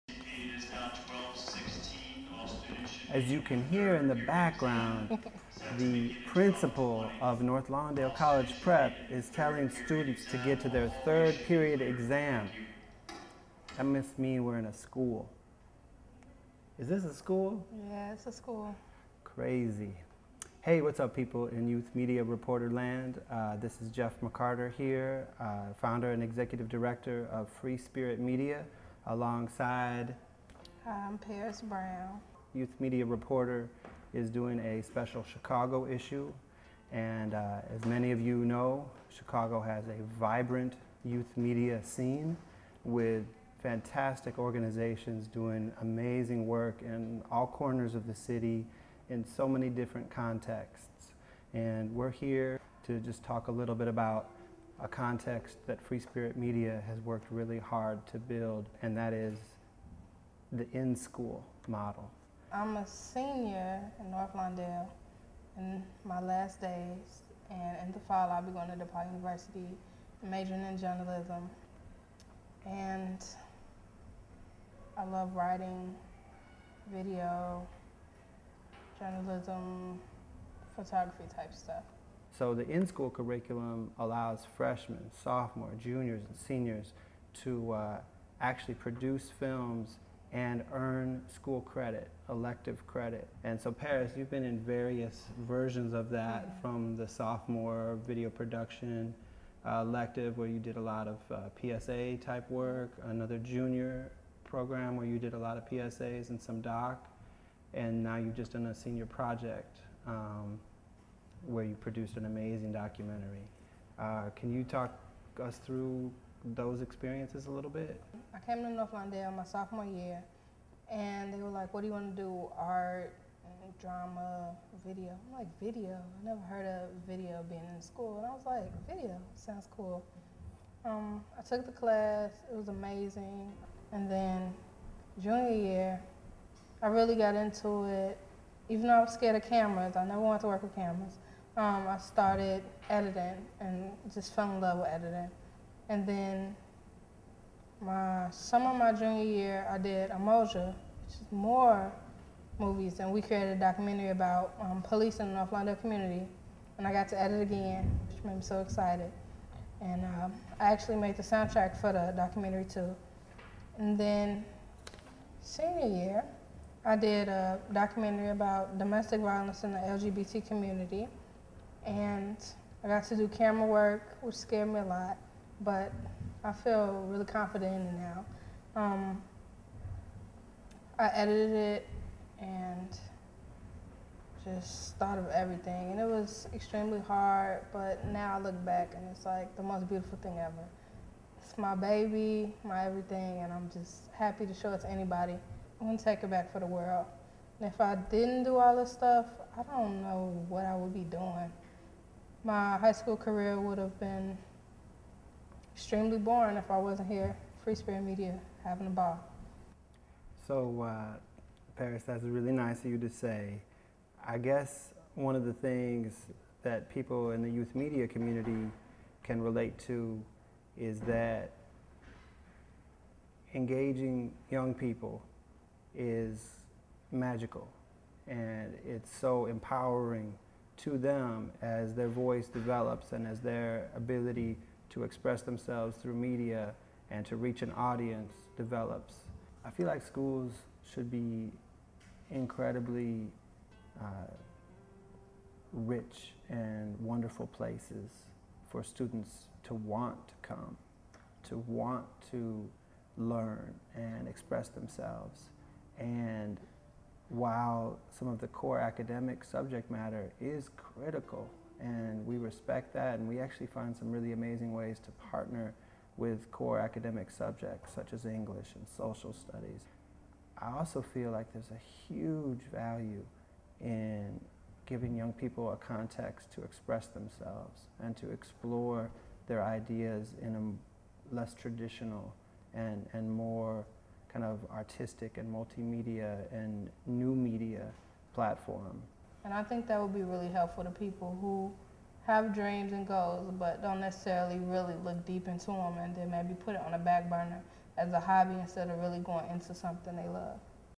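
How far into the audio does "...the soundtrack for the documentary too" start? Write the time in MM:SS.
02:41.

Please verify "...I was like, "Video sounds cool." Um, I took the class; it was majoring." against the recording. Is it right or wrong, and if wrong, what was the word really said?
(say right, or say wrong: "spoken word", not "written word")
wrong: "amazing", not "majoring".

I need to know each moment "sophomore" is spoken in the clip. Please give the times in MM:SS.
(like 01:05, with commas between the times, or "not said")
01:25, 01:37, 01:59.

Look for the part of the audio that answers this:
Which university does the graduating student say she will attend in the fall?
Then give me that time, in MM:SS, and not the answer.
01:08.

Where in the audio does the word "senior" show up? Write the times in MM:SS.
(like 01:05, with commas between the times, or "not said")
01:02, 01:26, 01:48, 02:45.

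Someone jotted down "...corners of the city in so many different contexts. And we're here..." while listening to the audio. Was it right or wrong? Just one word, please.
right.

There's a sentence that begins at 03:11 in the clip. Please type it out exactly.
It's my baby, my everything, and I'm just happy to show it to anybody.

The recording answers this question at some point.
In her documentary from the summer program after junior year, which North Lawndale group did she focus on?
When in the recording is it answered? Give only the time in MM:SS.
02:34.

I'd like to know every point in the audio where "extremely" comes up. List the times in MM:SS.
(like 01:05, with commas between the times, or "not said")
03:06, 03:25.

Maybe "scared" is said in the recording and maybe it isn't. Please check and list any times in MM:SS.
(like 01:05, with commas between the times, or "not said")
02:19, 02:54.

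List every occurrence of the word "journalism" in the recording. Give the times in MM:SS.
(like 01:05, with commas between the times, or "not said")
01:10, 01:18.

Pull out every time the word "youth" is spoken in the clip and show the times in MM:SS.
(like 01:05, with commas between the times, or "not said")
00:21, 00:32, 00:41, 03:37.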